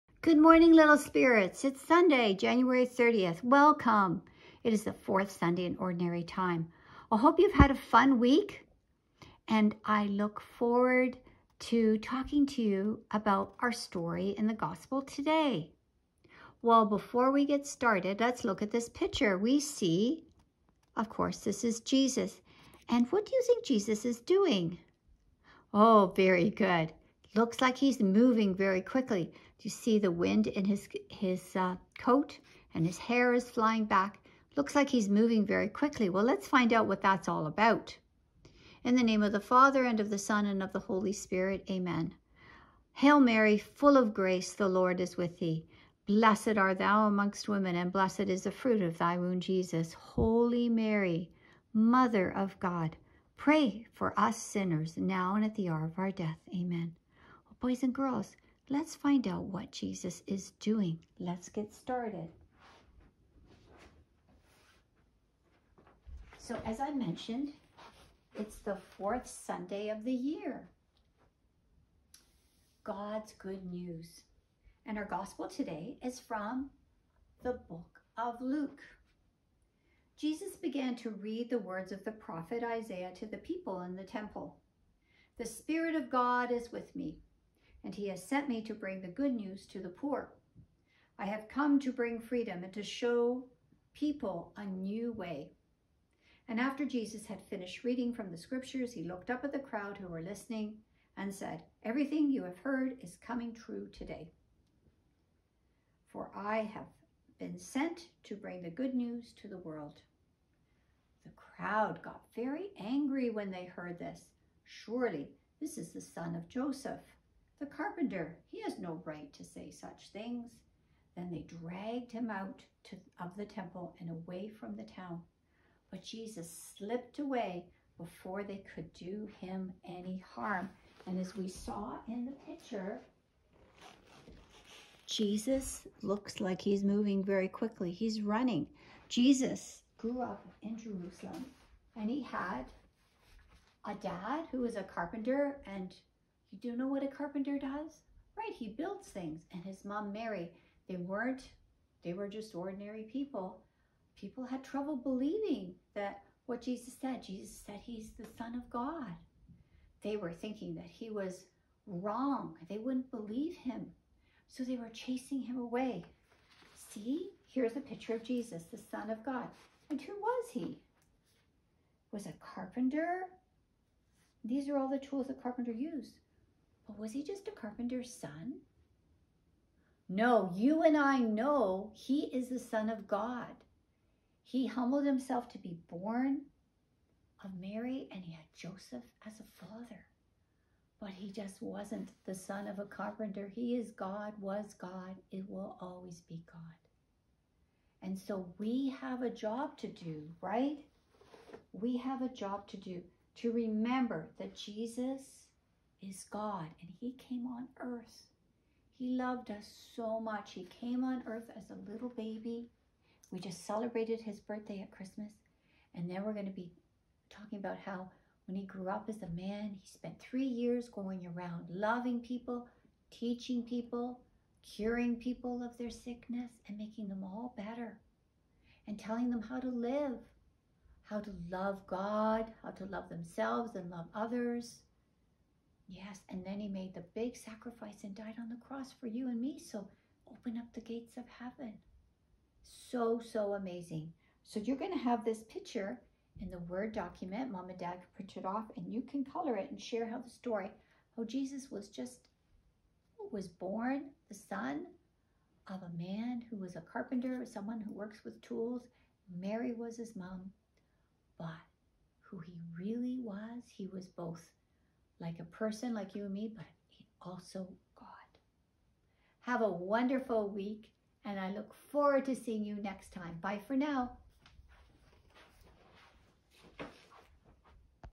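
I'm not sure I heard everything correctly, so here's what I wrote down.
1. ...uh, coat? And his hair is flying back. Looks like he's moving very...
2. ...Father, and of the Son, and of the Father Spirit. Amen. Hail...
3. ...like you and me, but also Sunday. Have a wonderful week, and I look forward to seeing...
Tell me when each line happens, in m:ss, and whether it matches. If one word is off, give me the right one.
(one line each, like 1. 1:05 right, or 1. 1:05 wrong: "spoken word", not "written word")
1. 0:31 right
2. 0:39 wrong: "Holy", not "Father"
3. 4:25 wrong: "God", not "Sunday".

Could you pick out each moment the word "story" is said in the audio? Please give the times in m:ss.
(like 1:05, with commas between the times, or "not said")
0:13, 4:10.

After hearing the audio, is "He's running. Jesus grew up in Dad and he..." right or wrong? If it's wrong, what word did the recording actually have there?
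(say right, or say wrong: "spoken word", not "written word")
wrong: "Jerusalem", not "Dad".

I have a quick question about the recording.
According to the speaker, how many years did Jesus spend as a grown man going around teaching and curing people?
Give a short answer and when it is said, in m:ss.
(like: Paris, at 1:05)
3, at 3:40.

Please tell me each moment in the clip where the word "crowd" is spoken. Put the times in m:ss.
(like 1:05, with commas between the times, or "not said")
1:39, 1:51.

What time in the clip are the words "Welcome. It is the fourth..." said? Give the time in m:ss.
0:03.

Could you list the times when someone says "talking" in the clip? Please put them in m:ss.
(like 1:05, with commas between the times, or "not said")
0:11, 3:37.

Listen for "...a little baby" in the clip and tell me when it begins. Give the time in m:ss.
3:31.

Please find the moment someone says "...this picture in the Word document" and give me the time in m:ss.
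4:05.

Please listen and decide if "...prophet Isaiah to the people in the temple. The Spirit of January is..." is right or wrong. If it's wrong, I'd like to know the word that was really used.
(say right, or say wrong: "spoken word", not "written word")
wrong: "God", not "January".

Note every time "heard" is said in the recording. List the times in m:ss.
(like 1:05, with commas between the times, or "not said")
1:42, 1:53.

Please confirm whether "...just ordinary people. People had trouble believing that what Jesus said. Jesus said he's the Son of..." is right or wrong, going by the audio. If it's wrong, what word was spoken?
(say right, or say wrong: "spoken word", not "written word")
right.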